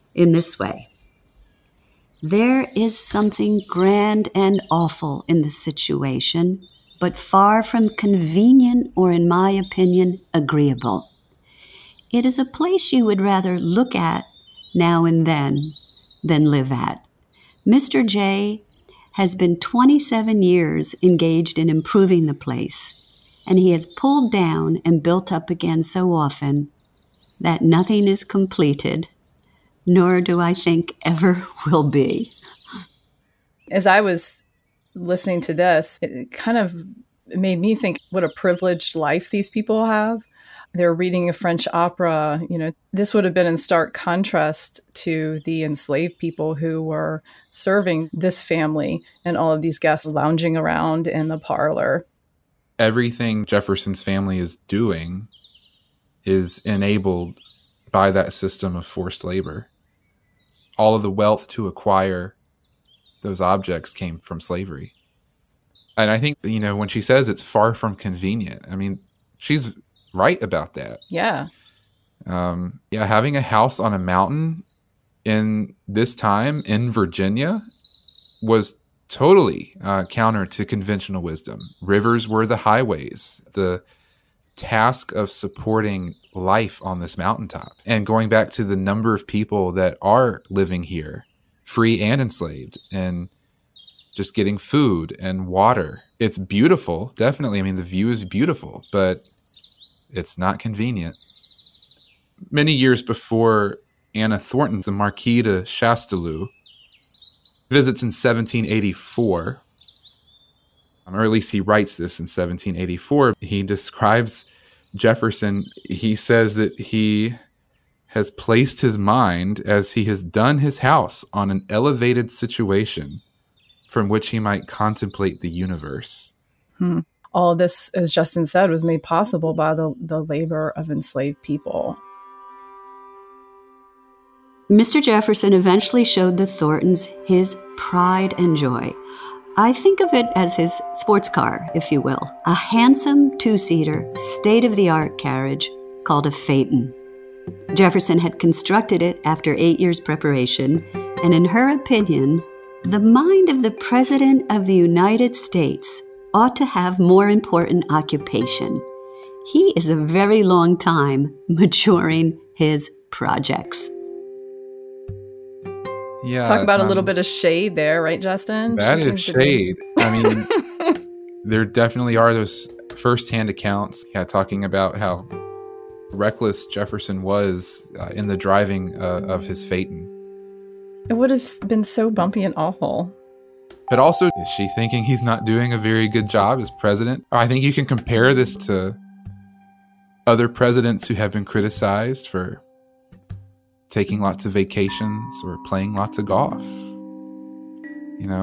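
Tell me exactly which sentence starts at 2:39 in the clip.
He is a very long time maturing his projects.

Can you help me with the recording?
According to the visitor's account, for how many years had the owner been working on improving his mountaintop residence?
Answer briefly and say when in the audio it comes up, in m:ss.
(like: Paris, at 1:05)
27 years, at 0:19.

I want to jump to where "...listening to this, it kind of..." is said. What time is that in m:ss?
0:34.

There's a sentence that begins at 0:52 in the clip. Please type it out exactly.
Everything Jefferson's family is doing is enabled by that system of forced labor.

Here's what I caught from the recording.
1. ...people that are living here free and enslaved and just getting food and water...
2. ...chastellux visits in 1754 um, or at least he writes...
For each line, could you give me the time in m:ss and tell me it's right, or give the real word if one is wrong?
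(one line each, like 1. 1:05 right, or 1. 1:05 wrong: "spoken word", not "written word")
1. 1:29 right
2. 1:45 wrong: "1784", not "1754".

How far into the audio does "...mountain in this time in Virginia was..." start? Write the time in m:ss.
1:13.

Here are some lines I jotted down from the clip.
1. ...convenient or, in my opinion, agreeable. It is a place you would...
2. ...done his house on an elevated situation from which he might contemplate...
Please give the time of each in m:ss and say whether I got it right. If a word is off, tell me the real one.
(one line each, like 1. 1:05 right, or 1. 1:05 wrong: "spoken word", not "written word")
1. 0:07 right
2. 2:00 right.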